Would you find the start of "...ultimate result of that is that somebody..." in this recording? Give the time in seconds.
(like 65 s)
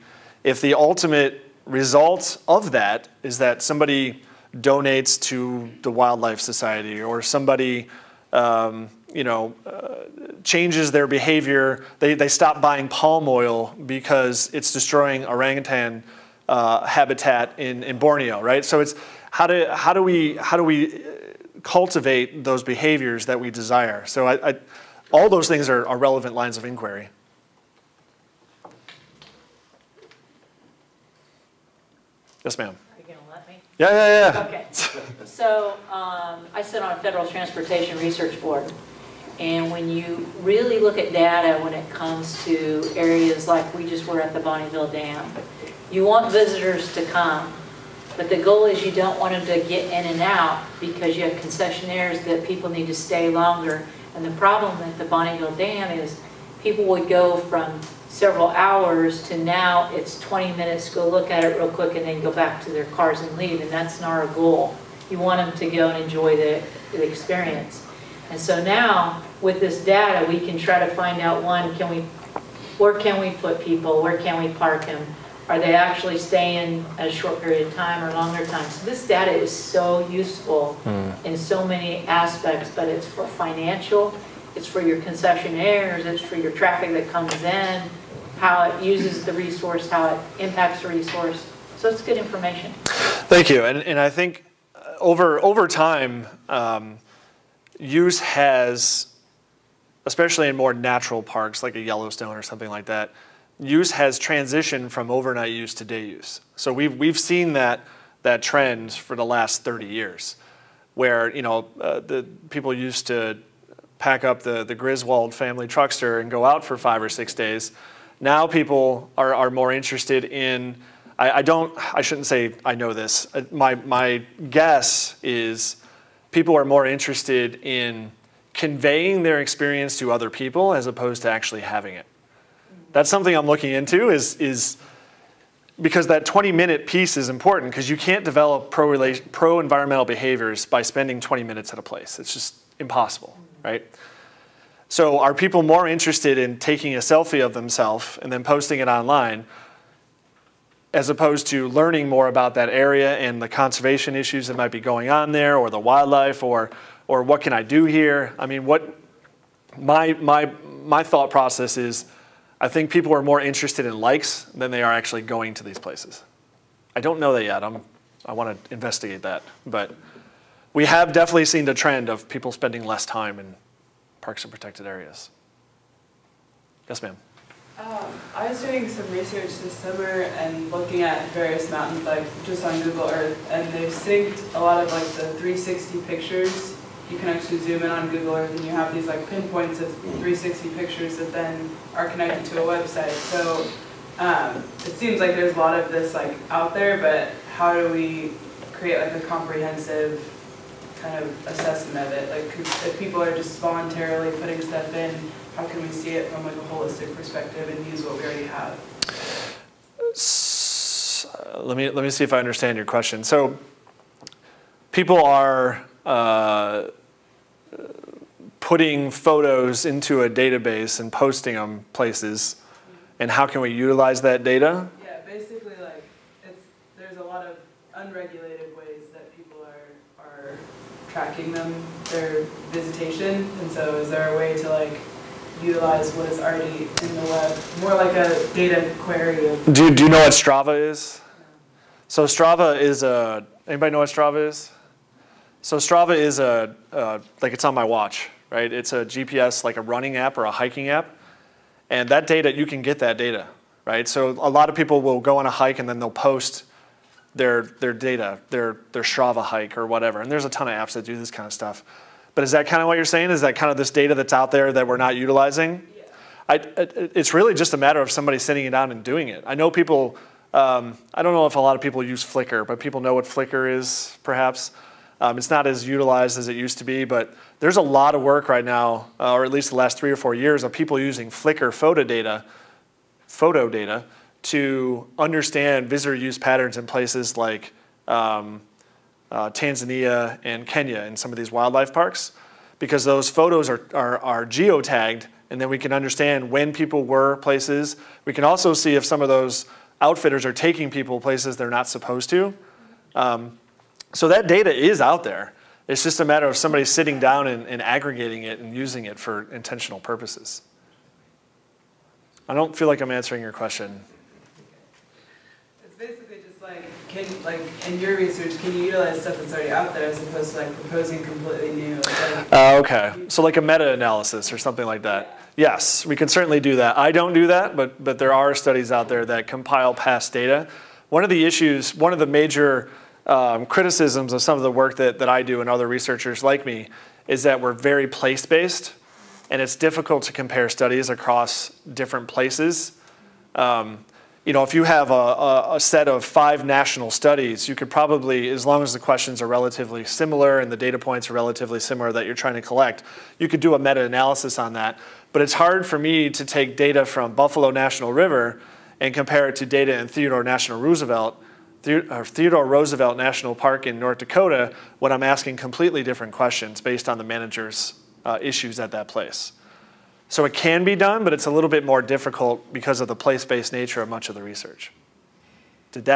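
0 s.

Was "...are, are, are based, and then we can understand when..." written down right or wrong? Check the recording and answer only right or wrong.
wrong.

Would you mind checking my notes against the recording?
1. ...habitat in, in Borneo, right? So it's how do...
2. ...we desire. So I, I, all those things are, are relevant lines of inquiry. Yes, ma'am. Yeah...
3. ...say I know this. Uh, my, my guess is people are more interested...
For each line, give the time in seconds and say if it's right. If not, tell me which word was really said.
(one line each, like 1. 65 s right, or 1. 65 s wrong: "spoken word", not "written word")
1. 16 s right
2. 23 s right
3. 122 s right.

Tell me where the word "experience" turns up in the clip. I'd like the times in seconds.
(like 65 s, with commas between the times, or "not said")
67 s, 129 s.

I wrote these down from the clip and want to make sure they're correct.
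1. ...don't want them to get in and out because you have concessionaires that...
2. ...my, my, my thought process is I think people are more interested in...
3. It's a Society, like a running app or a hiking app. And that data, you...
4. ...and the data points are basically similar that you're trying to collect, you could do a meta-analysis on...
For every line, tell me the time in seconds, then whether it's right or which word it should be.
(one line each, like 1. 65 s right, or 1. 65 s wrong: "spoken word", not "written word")
1. 48 s right
2. 159 s right
3. 248 s wrong: "GPS", not "Society"
4. 350 s wrong: "relatively", not "basically".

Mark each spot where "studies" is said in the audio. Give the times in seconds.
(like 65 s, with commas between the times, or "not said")
328 s, 340 s, 347 s.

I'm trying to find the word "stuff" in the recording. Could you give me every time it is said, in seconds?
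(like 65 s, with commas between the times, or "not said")
204 s, 261 s, 319 s.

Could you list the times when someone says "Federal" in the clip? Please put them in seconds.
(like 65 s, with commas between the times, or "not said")
37 s.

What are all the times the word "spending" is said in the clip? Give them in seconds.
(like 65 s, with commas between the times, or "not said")
140 s, 172 s.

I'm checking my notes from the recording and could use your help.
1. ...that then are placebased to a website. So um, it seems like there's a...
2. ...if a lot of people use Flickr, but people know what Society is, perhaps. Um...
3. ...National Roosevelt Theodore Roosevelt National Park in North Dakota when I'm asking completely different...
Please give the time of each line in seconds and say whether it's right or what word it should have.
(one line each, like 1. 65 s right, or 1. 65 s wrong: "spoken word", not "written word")
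1. 191 s wrong: "connected", not "placebased"
2. 271 s wrong: "Flickr", not "Society"
3. 360 s right.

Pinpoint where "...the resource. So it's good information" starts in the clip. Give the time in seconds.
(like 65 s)
90 s.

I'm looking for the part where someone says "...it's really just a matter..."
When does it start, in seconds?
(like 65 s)
267 s.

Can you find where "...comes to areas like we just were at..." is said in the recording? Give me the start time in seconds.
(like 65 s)
41 s.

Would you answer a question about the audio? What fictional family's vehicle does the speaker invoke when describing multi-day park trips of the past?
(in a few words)
Griswold family truckster.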